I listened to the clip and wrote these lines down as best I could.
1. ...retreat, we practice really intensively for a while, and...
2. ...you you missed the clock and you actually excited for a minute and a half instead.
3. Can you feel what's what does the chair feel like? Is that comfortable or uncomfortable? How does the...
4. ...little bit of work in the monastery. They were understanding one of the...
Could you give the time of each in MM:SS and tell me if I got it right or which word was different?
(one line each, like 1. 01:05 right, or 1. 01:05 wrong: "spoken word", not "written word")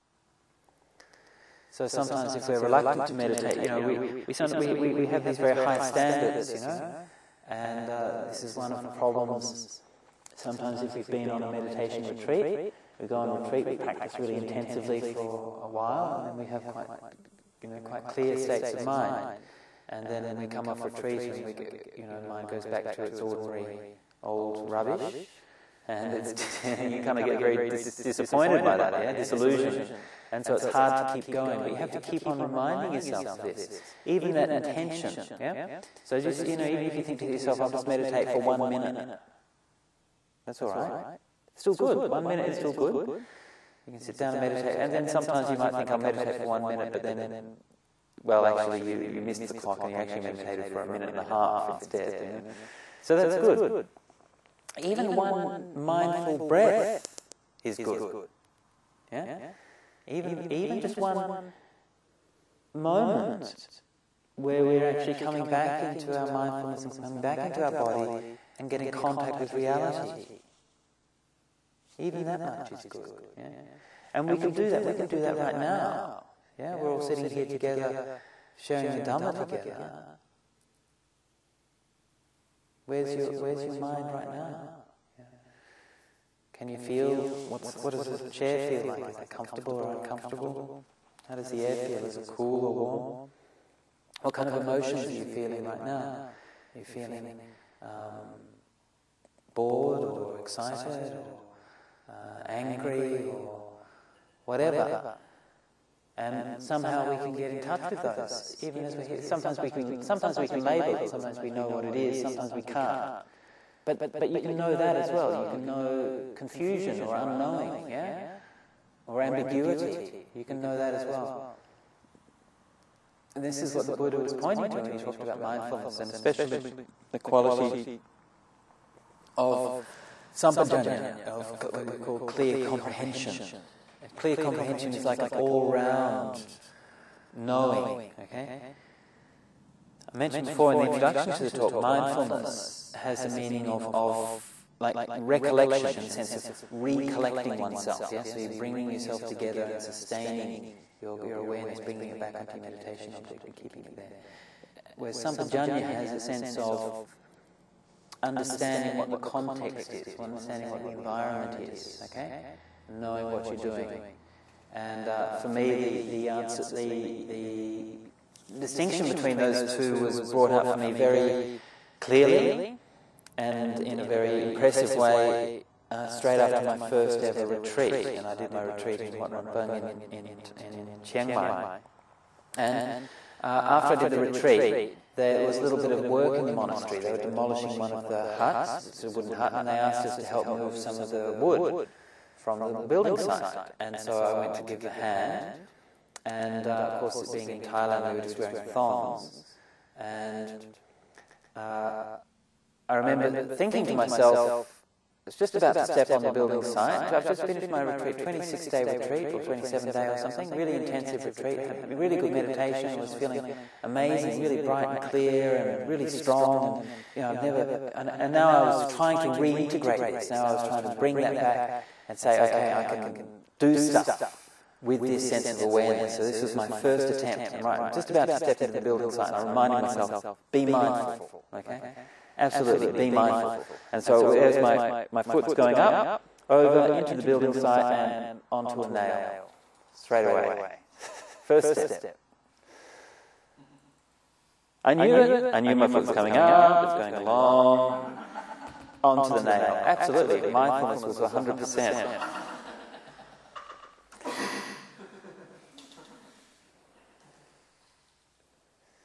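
1. 00:13 right
2. 00:48 wrong: "meditated", not "excited"
3. 01:26 right
4. 03:05 wrong: "demolishing", not "understanding".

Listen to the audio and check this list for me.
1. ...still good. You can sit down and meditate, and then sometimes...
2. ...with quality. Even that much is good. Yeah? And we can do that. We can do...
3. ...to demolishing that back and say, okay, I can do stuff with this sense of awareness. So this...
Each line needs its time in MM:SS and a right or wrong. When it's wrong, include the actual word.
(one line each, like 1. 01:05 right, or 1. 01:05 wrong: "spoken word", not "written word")
1. 00:42 right
2. 01:09 wrong: "reality", not "quality"
3. 03:40 wrong: "bring", not "demolishing".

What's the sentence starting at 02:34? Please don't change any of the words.
Whereas sampajanya has a sense of understanding what the context is, understanding what the environment is, okay, and knowing what you're doing.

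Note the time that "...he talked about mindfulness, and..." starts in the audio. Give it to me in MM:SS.
02:04.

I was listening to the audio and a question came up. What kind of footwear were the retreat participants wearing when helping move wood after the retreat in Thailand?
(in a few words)
thongs.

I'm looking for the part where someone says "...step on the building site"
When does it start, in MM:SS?
03:25.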